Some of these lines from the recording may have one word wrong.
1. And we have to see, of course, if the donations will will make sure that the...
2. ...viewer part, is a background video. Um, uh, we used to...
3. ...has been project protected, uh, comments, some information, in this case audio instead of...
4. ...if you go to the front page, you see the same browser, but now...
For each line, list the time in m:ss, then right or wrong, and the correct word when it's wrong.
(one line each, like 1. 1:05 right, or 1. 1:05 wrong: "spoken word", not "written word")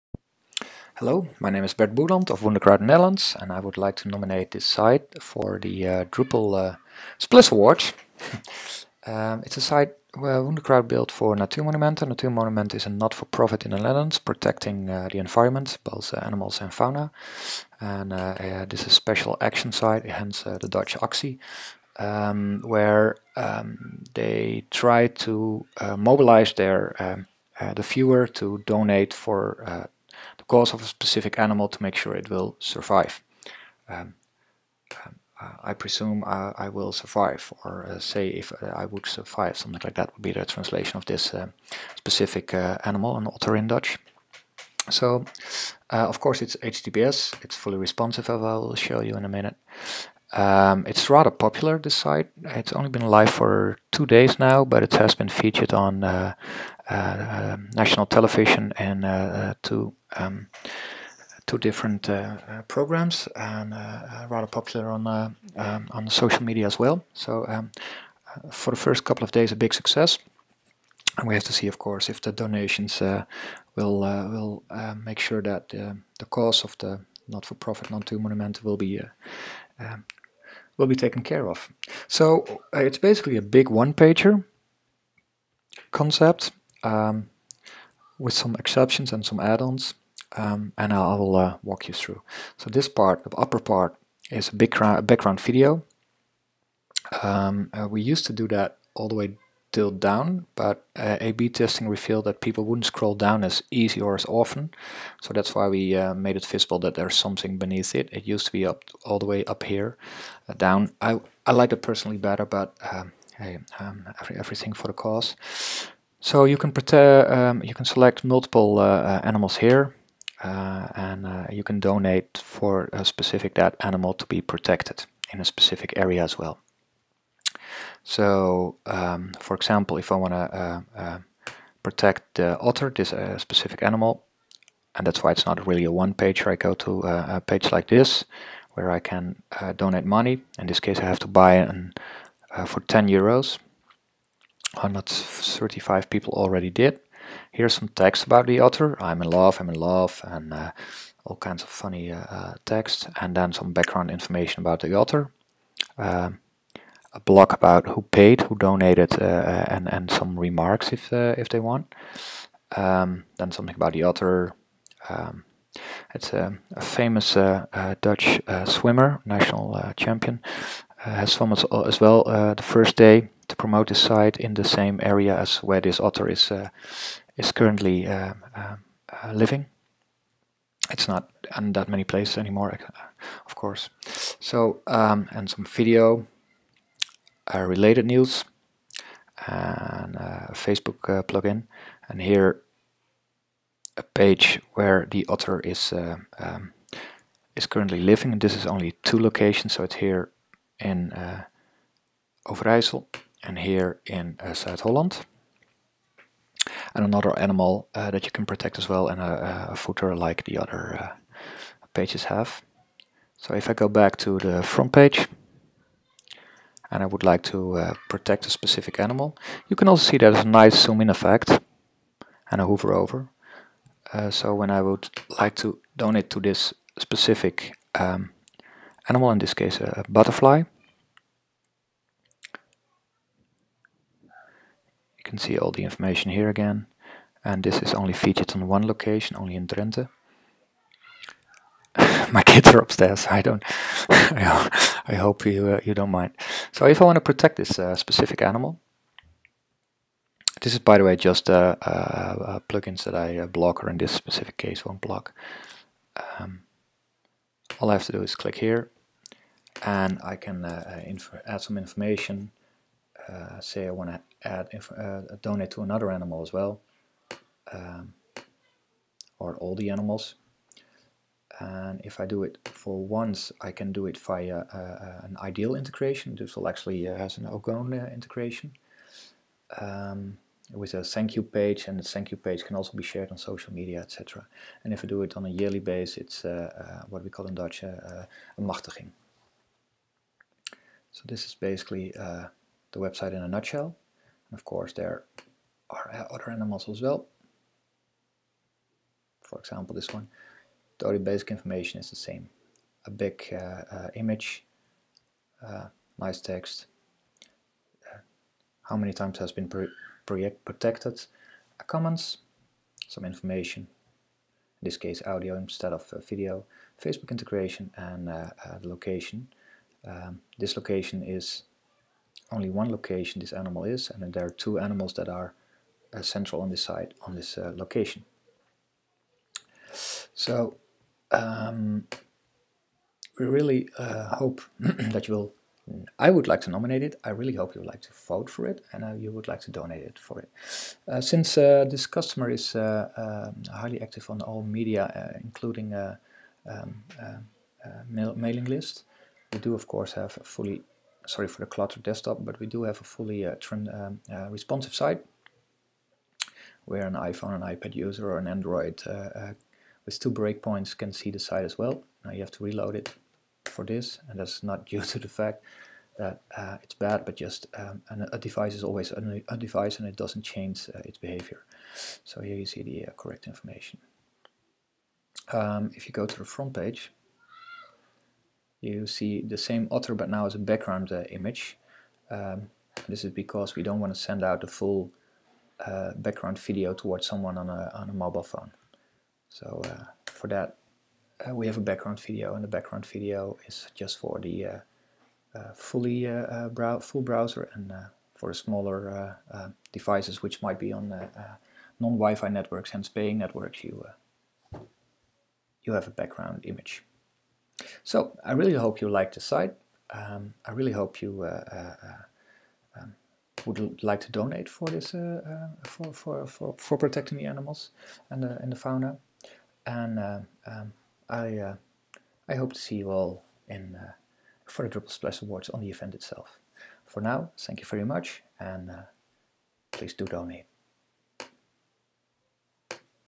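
1. 1:11 right
2. 1:33 wrong: "upper", not "viewer"
3. 5:09 right
4. 6:15 wrong: "otter", not "browser".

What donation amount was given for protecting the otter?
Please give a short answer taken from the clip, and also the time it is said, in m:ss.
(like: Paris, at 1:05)
10 euros, at 2:22.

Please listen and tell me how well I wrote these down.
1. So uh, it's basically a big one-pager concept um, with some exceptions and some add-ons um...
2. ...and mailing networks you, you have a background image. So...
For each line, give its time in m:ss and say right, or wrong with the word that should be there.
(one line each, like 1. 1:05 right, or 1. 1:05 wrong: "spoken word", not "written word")
1. 1:22 right
2. 6:42 wrong: "paying", not "mailing".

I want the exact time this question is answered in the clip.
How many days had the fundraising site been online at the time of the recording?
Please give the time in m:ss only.
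0:53.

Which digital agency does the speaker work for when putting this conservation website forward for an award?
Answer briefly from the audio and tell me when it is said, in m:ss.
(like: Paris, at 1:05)
Wunderkraut Netherlands, at 0:02.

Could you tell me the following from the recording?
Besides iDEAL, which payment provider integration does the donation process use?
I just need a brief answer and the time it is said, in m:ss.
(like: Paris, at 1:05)
Ogone, at 4:37.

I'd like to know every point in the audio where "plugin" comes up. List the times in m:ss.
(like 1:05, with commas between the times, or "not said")
3:11, 4:12.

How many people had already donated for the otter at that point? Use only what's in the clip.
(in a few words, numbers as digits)
135.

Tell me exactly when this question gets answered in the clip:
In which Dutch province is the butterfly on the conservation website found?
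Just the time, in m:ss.
3:59.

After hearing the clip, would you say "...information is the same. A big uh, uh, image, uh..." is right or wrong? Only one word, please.
right.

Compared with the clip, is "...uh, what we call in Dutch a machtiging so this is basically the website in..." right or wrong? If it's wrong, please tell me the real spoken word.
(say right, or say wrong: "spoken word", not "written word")
right.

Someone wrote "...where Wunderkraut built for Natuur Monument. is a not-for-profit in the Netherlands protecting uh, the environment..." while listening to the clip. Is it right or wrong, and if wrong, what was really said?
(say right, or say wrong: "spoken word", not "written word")
right.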